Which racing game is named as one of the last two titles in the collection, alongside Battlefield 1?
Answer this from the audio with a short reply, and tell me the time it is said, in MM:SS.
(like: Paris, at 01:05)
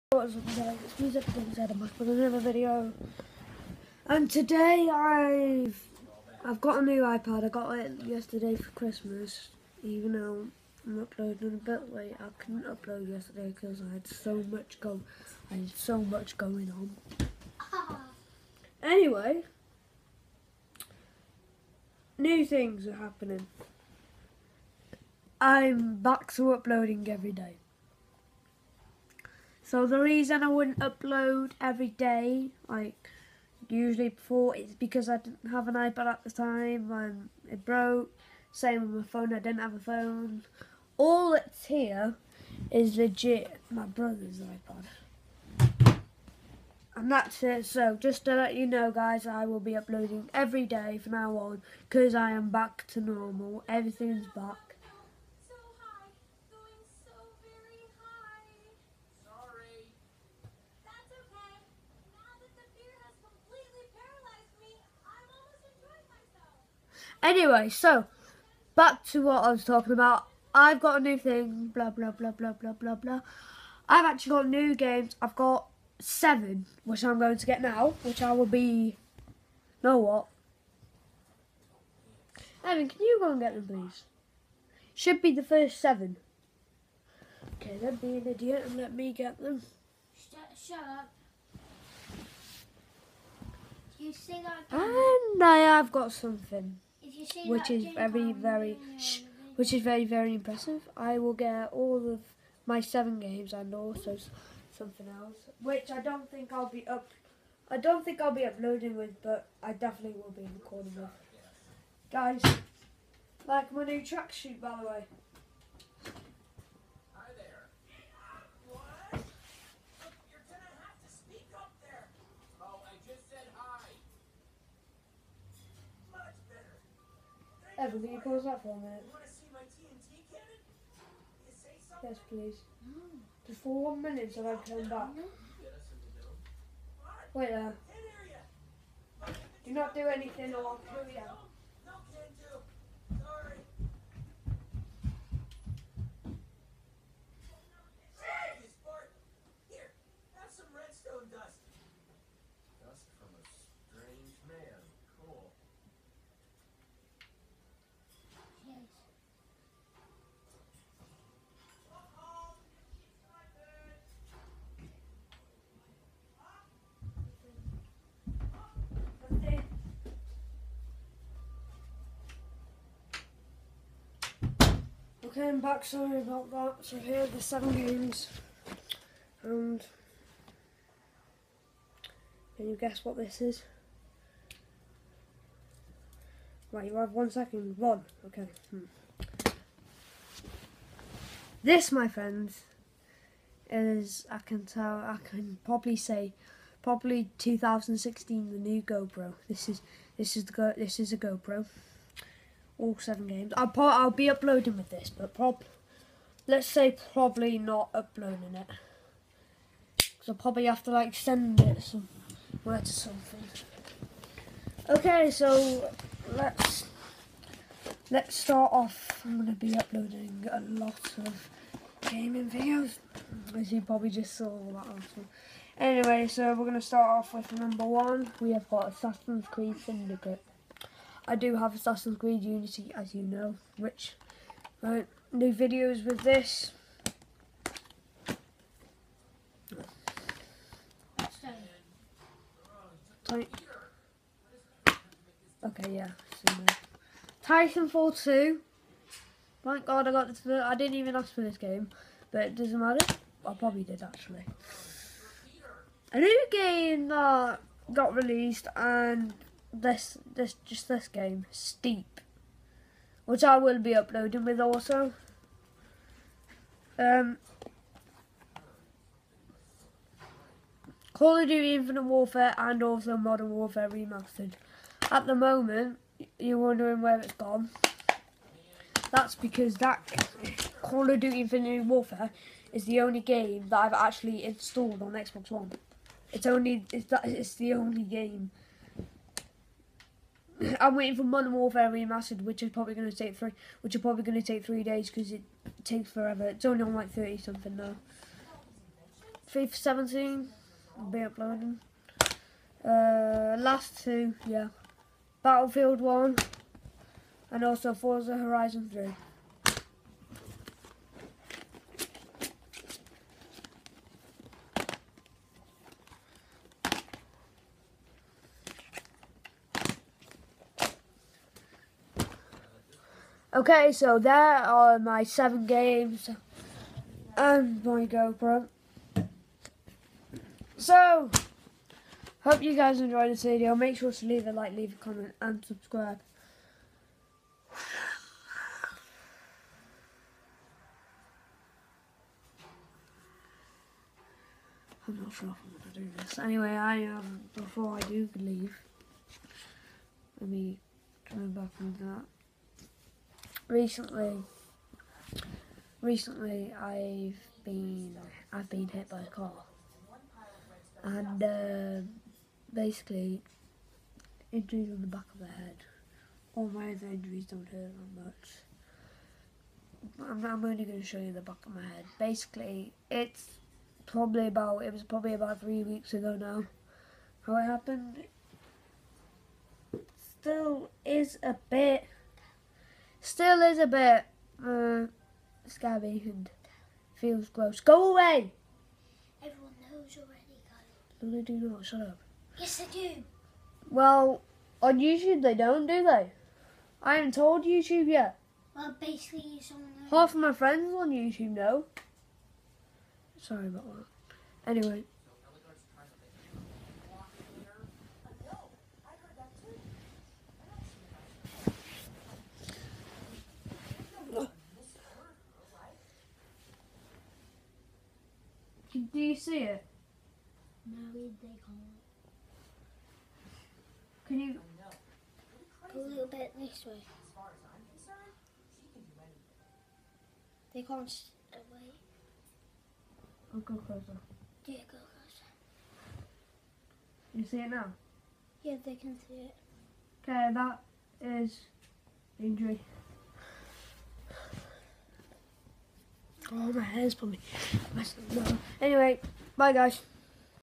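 Forza Horizon 3, at 05:07.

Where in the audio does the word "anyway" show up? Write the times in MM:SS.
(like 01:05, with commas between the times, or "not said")
00:18, 01:07, 03:45, 05:46, 06:44, 07:28.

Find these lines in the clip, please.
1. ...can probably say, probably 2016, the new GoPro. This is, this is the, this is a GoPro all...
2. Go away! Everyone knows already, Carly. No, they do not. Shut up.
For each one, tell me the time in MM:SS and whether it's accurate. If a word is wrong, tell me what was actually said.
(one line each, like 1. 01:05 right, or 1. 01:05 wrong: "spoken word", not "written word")
1. 03:15 right
2. 06:27 right.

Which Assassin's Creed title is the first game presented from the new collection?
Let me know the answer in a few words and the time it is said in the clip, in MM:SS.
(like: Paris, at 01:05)
Assassin's Creed Syndicate, at 03:48.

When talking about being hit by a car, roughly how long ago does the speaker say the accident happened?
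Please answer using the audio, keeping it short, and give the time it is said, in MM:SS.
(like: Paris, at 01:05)
3 weeks ago, at 06:15.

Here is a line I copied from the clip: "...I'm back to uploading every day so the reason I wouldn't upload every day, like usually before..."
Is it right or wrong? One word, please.
right.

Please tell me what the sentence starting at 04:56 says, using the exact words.
It's only on like thirty something now.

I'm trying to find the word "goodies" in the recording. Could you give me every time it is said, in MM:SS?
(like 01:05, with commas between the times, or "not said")
not said.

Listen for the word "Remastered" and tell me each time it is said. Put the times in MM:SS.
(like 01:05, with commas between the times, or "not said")
04:33, 04:51.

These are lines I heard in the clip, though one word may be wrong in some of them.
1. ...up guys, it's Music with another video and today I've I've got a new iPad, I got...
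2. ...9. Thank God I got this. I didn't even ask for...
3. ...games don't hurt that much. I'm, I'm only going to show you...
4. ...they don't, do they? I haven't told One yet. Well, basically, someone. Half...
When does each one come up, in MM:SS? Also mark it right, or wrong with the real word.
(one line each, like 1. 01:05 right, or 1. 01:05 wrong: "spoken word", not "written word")
1. 00:00 right
2. 04:08 wrong: "2", not "9"
3. 06:07 wrong: "injuries", not "games"
4. 06:35 wrong: "YouTube", not "One".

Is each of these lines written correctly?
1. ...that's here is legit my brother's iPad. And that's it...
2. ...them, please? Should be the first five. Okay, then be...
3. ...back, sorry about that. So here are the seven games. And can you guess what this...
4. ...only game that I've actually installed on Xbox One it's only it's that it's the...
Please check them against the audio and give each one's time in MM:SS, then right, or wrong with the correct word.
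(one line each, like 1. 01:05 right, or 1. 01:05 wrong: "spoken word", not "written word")
1. 00:41 right
2. 01:23 wrong: "seven", not "five"
3. 02:55 right
4. 04:43 right.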